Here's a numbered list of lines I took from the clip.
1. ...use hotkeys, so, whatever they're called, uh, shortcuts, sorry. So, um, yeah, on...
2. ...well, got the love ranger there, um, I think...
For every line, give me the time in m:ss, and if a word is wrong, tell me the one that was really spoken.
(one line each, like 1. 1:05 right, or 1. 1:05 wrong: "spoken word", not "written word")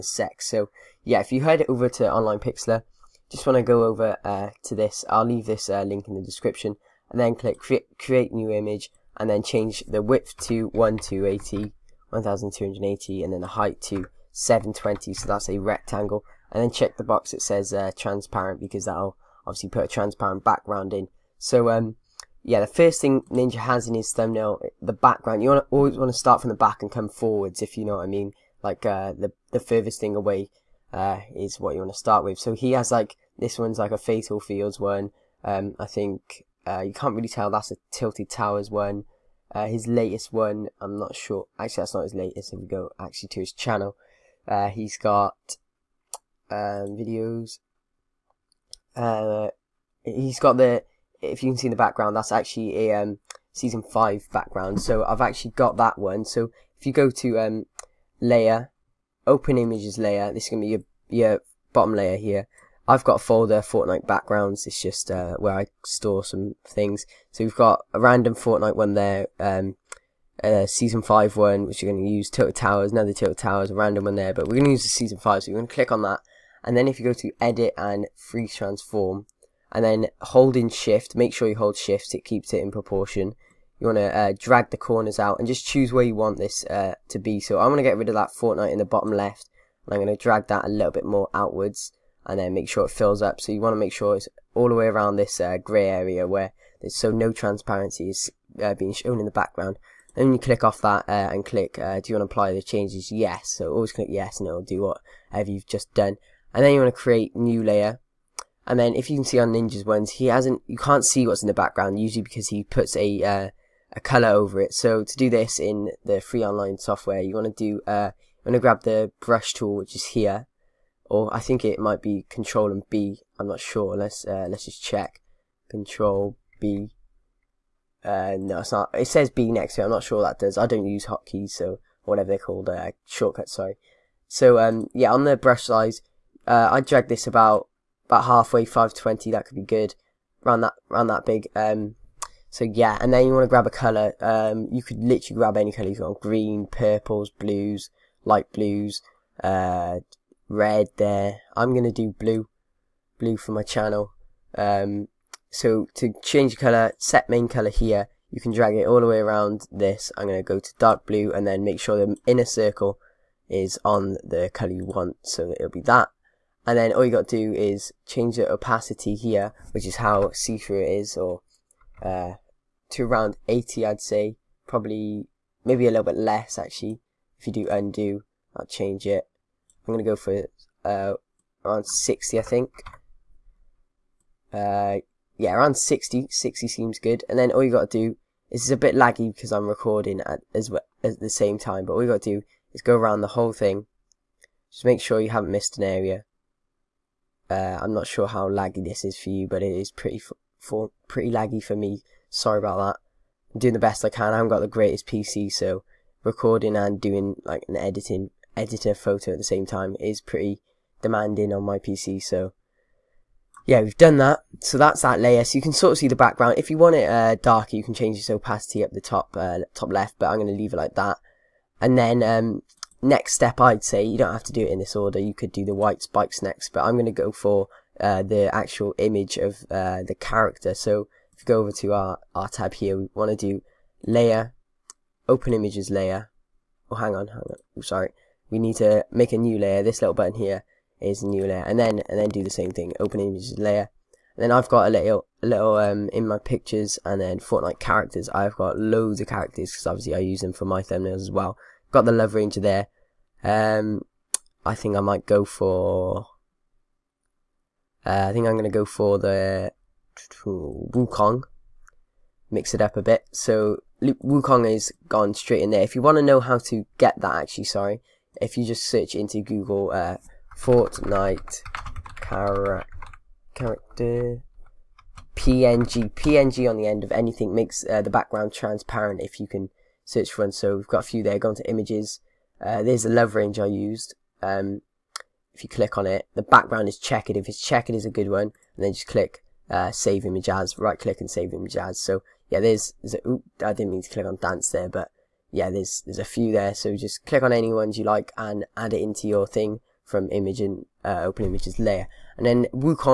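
1. 2:10 right
2. 4:11 right.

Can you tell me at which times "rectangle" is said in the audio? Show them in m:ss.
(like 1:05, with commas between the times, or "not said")
0:15.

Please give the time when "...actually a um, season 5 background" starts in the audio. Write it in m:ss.
0:52.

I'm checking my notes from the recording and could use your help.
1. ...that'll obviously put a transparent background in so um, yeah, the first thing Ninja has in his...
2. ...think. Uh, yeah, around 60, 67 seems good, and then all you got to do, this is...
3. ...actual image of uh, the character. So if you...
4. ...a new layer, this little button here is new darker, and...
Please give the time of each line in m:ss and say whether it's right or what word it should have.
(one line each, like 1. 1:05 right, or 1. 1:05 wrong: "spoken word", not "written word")
1. 0:18 right
2. 3:02 wrong: "60", not "67"
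3. 3:48 right
4. 3:59 wrong: "layer", not "darker".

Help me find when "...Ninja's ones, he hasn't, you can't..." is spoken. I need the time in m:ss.
1:49.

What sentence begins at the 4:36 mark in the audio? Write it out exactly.
PNG on the end of anything makes uh, the background transparent if you can search for one.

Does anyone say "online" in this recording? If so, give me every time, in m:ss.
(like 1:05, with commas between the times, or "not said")
0:02, 1:56.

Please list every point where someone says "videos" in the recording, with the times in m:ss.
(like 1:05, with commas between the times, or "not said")
0:46.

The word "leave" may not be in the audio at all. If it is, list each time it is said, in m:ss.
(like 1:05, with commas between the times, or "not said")
0:05, 3:40.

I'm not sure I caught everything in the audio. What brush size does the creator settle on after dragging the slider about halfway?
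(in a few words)
520.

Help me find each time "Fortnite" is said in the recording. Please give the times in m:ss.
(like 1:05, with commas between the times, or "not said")
1:03, 1:08, 1:28, 4:07, 4:30.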